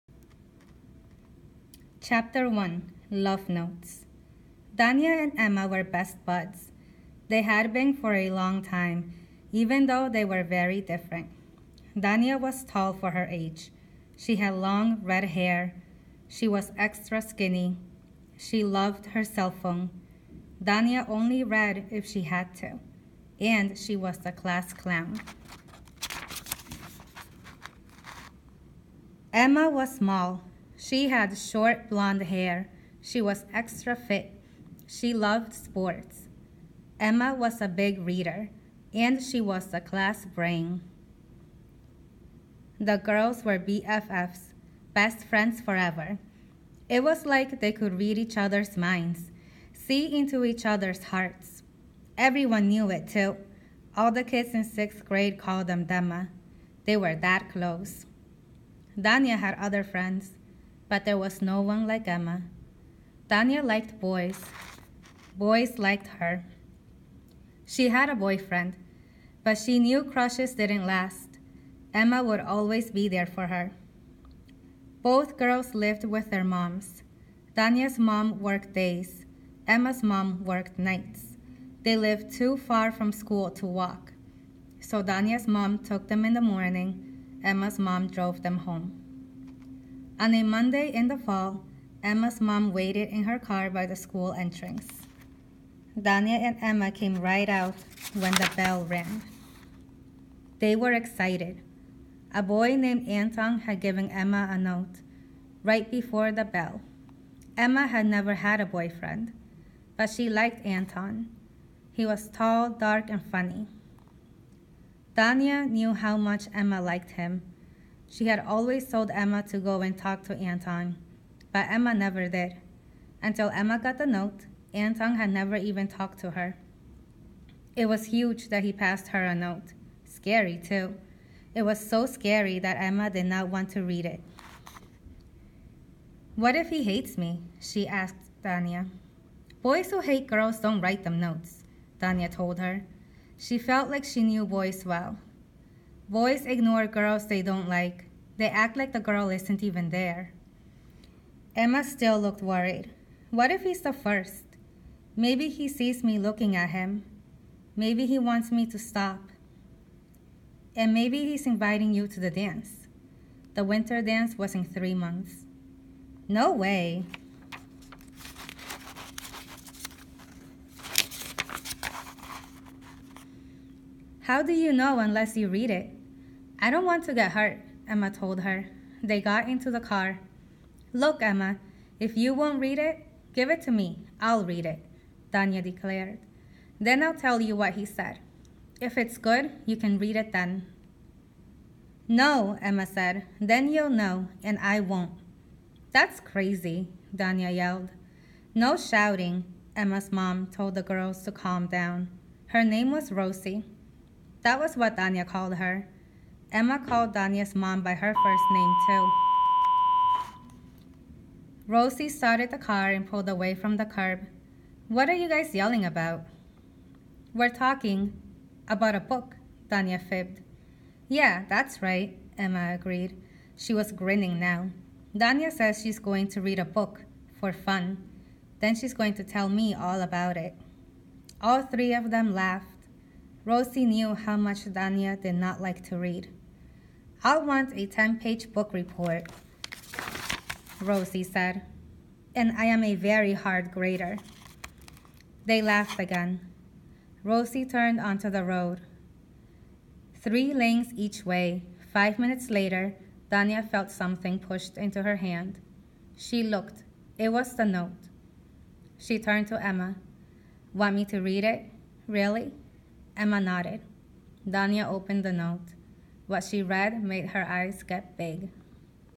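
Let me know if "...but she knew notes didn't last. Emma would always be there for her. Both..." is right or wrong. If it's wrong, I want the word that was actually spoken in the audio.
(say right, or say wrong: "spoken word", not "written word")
wrong: "crushes", not "notes".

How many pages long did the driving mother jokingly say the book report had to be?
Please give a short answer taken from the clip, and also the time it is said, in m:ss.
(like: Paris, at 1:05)
10, at 3:57.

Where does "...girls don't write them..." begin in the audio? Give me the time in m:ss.
2:20.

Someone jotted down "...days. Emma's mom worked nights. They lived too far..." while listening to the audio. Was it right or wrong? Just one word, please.
right.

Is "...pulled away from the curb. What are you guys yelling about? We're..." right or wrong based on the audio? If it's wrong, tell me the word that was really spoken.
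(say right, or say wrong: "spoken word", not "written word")
right.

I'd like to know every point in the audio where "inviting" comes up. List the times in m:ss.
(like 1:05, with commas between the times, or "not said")
2:41.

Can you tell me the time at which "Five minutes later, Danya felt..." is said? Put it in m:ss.
4:11.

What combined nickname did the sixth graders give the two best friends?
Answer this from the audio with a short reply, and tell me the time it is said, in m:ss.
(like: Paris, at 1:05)
Dema, at 0:55.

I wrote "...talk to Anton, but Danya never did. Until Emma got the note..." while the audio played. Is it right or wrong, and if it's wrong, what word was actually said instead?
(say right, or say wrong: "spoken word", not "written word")
wrong: "Emma", not "Danya".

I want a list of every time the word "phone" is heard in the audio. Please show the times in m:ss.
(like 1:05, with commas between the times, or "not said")
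0:19.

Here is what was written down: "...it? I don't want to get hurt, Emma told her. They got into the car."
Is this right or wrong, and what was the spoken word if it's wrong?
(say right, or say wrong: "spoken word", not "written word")
right.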